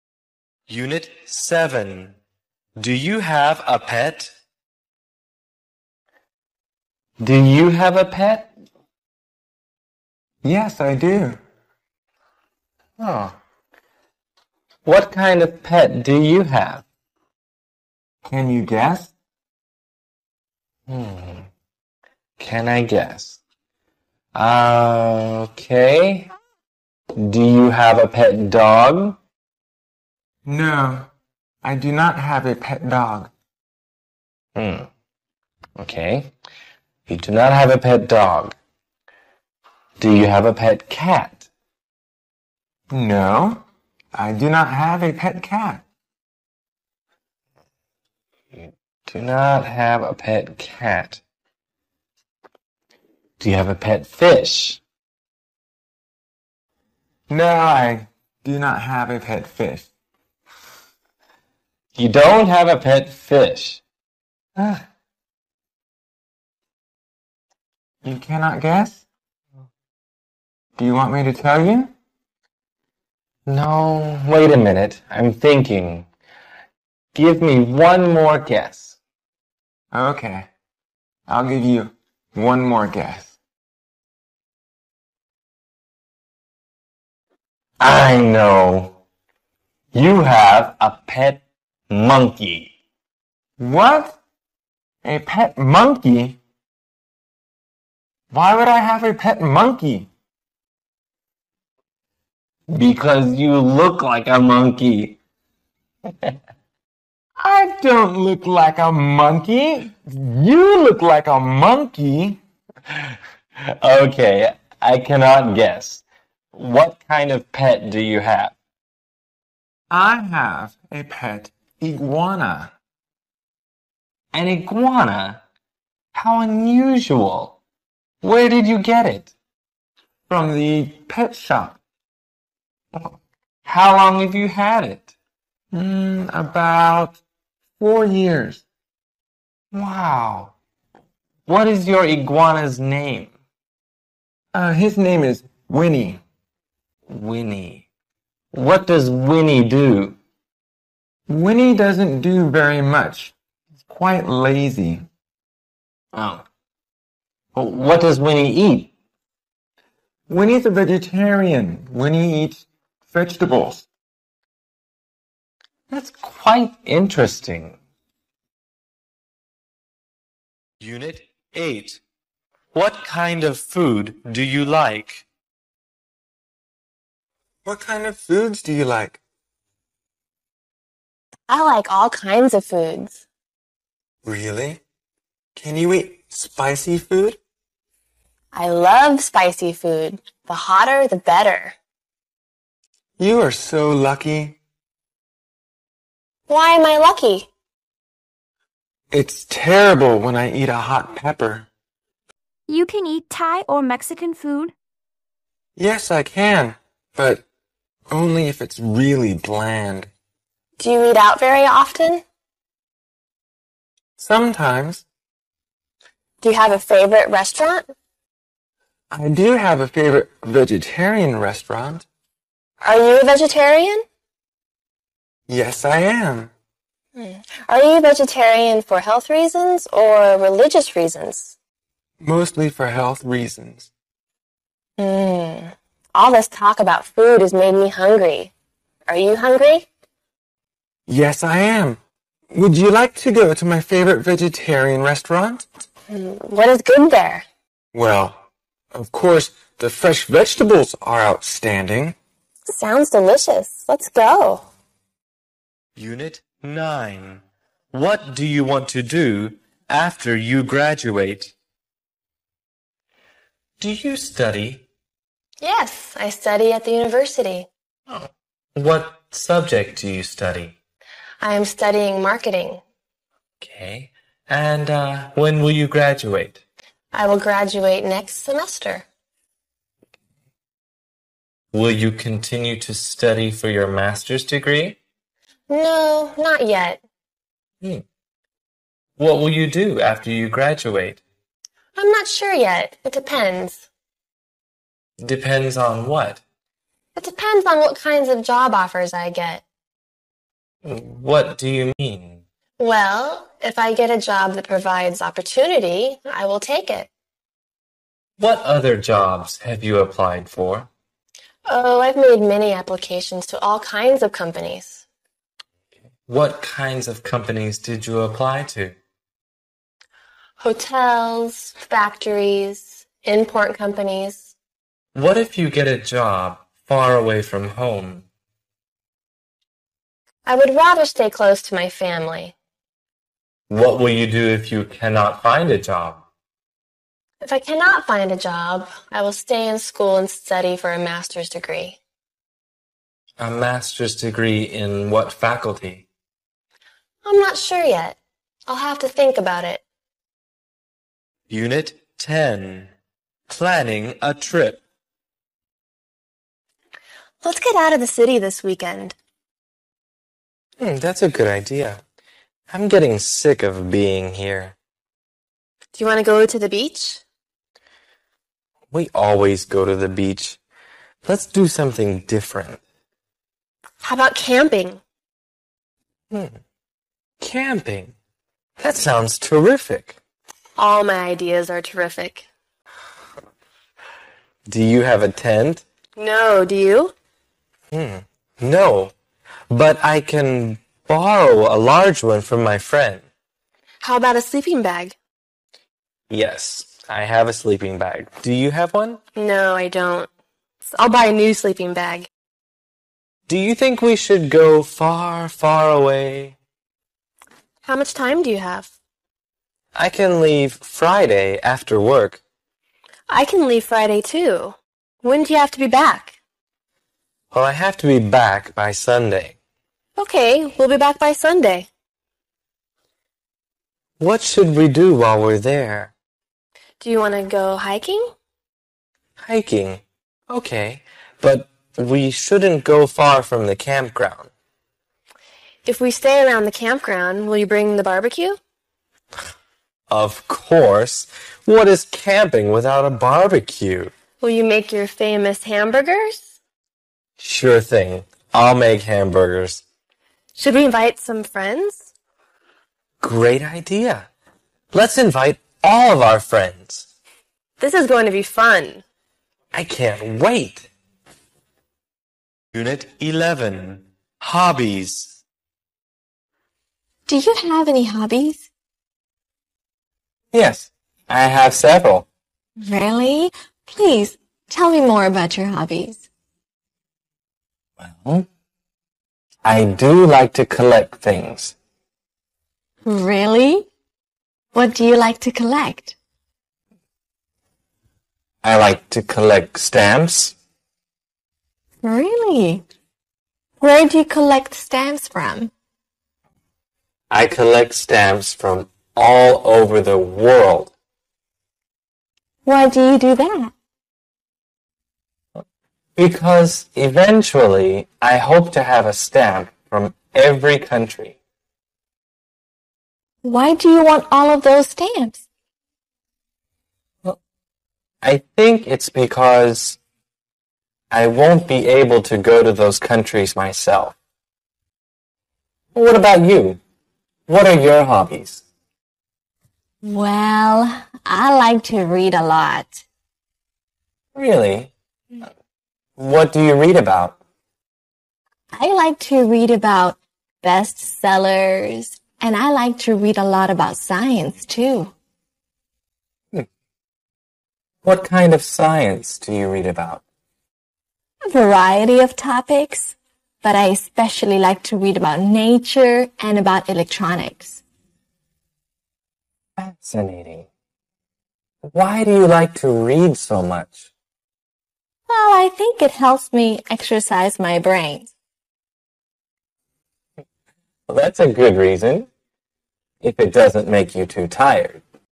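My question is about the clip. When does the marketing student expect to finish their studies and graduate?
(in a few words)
next semester.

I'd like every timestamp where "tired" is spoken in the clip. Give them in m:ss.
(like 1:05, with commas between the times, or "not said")
9:34.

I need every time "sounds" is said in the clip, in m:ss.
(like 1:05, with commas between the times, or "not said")
4:12, 6:18.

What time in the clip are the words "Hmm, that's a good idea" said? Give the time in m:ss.
6:00.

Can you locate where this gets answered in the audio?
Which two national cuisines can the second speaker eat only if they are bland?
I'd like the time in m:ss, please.
3:23.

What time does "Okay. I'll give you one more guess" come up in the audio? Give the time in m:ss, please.
1:19.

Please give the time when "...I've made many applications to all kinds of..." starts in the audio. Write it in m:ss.
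5:12.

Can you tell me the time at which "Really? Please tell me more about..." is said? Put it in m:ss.
7:52.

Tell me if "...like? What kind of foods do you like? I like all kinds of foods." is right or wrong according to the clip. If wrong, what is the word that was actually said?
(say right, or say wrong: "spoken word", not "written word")
right.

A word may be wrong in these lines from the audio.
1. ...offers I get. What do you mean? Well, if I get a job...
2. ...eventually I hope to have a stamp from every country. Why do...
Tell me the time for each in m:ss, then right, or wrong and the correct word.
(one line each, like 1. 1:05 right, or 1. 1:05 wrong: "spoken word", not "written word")
1. 4:58 right
2. 8:26 right.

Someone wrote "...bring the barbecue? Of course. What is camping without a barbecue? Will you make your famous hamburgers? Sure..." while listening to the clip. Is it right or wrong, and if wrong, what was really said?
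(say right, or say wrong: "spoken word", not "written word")
right.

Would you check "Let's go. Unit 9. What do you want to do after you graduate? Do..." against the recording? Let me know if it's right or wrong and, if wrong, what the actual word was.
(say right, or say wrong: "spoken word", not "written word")
right.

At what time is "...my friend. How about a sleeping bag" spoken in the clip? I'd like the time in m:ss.
6:32.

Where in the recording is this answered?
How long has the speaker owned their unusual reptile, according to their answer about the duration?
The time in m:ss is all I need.
2:16.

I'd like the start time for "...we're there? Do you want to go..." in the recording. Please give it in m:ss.
7:05.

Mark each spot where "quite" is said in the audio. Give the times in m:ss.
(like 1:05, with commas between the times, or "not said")
2:33, 2:46.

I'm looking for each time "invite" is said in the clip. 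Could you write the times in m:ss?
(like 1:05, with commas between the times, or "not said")
7:30, 7:35.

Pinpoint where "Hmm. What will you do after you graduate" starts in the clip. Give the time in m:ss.
4:47.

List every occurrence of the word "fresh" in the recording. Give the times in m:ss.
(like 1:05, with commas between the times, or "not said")
4:09.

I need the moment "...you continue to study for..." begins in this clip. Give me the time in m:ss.
4:41.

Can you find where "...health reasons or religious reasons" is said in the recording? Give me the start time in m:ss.
3:49.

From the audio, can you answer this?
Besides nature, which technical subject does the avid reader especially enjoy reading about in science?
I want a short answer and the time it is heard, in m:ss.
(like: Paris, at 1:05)
electronics, at 9:16.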